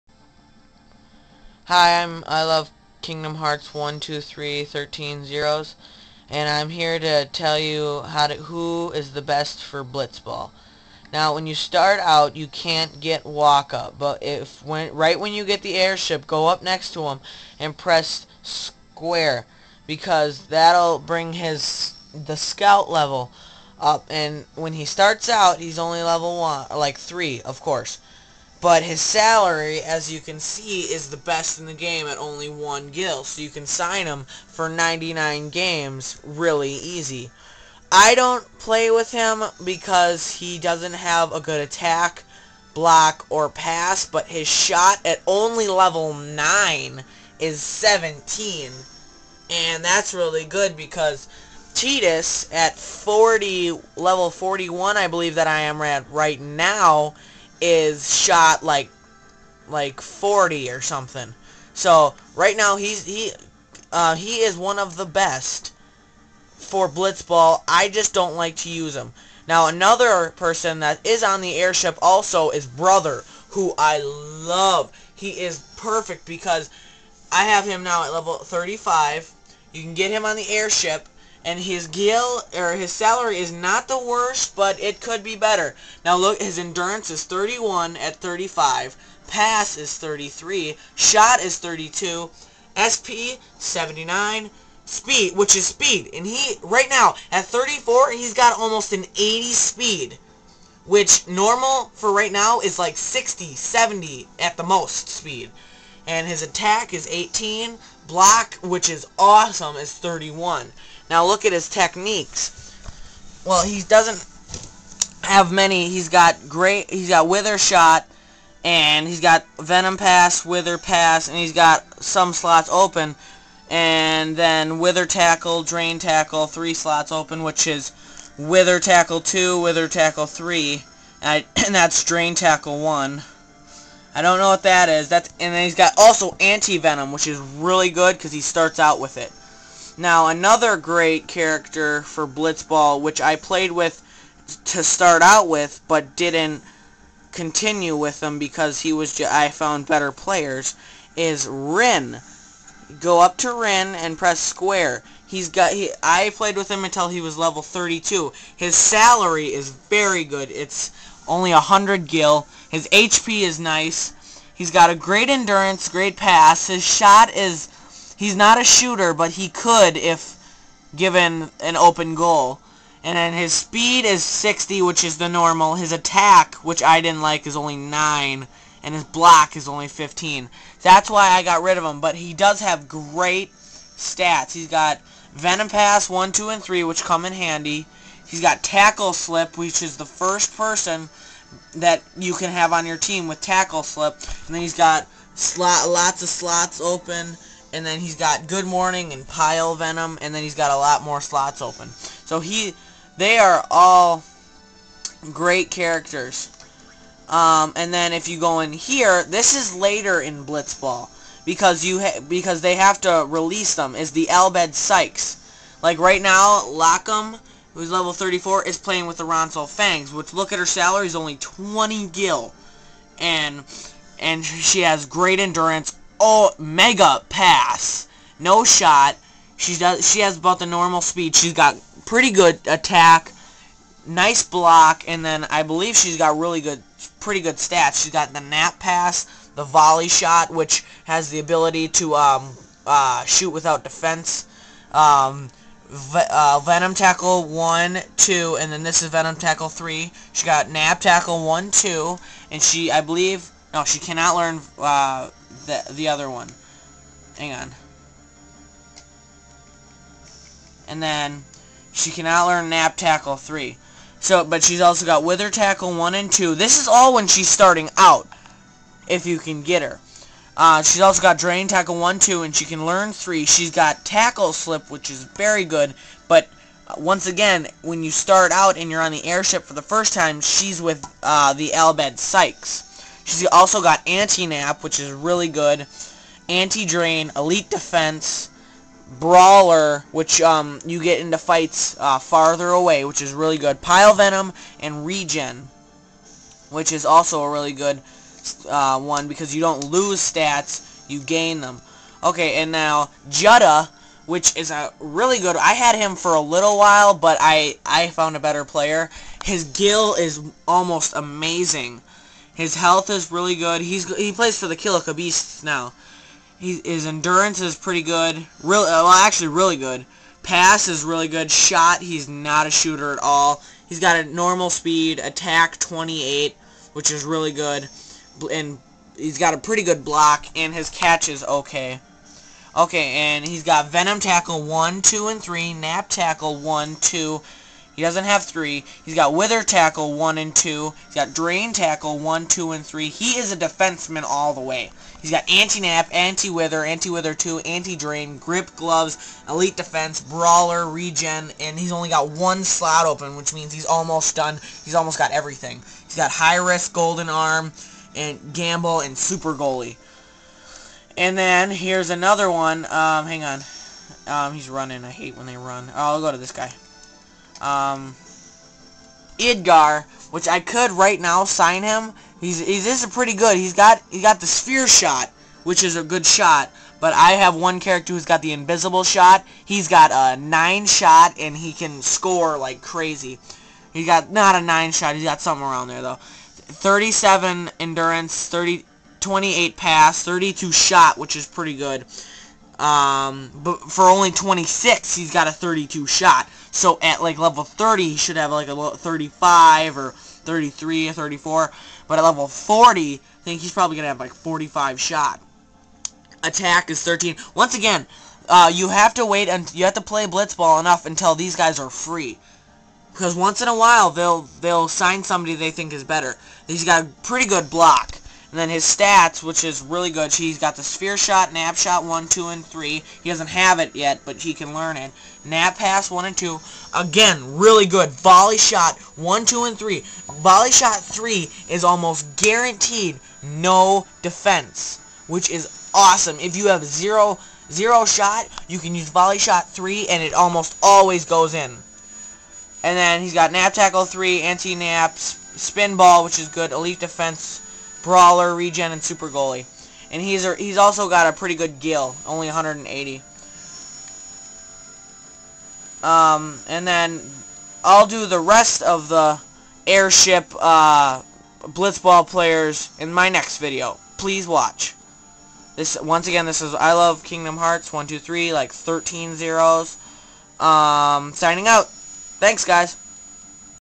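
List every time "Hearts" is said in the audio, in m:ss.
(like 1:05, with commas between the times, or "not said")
0:03, 7:47.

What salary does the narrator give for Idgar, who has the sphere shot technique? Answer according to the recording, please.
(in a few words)
180.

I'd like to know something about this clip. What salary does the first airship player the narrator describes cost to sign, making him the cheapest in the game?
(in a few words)
1 gil.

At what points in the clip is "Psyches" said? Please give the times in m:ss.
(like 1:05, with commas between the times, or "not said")
3:34, 4:42.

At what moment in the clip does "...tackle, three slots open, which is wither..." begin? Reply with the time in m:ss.
2:05.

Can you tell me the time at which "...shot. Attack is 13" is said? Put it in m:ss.
6:44.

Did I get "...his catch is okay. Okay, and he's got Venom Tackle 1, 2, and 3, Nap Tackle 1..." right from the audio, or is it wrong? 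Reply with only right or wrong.
right.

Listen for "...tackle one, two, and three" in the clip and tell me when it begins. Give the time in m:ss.
5:41.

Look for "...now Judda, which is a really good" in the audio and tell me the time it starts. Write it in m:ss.
5:02.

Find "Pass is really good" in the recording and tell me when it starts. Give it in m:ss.
5:20.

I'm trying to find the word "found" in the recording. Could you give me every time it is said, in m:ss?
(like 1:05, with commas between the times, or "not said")
2:29, 5:08.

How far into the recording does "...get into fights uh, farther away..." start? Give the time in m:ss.
4:50.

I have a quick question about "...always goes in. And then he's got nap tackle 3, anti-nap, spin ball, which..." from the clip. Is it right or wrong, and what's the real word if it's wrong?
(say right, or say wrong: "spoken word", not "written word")
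right.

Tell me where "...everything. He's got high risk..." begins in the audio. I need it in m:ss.
5:55.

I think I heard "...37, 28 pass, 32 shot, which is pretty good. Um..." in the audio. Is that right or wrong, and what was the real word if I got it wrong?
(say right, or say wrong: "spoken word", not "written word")
wrong: "30", not "37".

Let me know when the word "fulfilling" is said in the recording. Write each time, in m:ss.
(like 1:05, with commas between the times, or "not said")
not said.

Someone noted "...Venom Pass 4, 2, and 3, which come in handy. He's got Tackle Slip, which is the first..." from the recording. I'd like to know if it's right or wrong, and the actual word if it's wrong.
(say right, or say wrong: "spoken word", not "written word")
wrong: "1", not "4".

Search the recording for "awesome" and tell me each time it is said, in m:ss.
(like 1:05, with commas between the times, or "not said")
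1:49, 7:15.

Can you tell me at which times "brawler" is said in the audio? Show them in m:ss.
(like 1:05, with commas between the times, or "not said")
4:49, 5:50, 7:28.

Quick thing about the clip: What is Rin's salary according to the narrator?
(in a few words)
100 gil.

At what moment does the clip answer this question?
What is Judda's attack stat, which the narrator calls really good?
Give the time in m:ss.
5:25.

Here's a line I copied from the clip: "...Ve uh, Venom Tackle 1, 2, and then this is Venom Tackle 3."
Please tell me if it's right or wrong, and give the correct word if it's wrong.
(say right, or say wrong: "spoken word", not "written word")
right.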